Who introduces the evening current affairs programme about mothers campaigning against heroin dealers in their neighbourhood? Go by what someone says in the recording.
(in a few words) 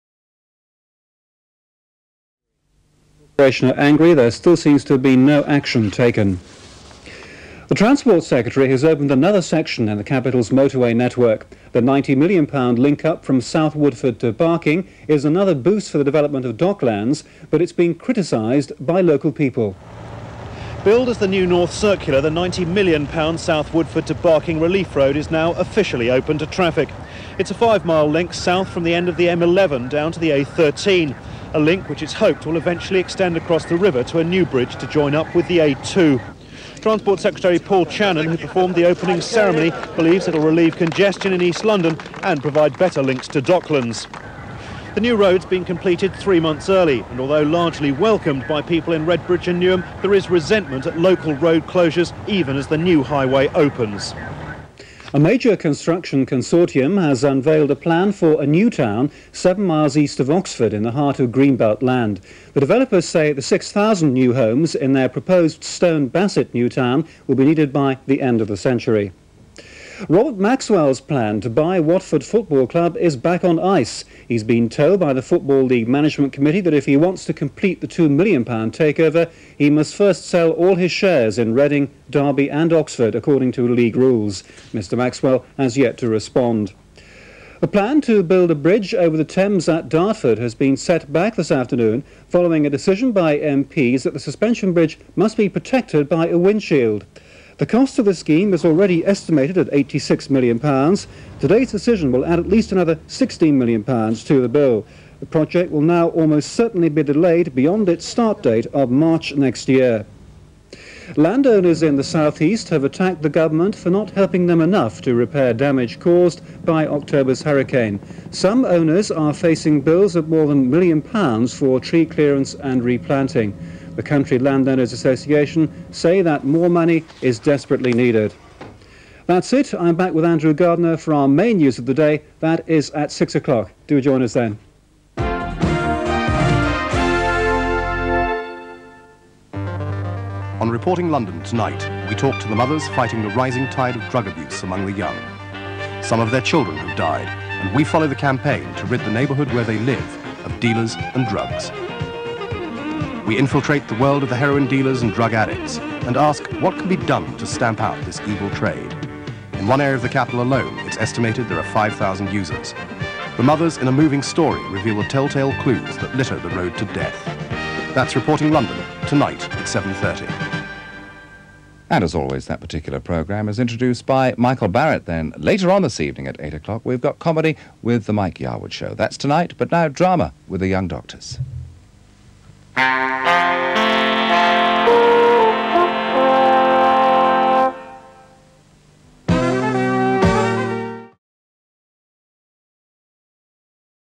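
Michael Barratt.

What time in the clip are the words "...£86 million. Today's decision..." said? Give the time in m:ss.
1:39.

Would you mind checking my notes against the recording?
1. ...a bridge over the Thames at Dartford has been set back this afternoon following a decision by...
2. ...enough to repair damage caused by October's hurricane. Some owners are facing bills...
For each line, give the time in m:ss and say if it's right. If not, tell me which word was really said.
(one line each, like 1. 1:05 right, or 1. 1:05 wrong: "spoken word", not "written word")
1. 1:28 right
2. 1:54 right.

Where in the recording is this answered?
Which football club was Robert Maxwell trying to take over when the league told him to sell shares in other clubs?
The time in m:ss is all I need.
1:11.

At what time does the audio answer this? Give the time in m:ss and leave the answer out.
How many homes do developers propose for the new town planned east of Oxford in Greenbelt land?
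1:03.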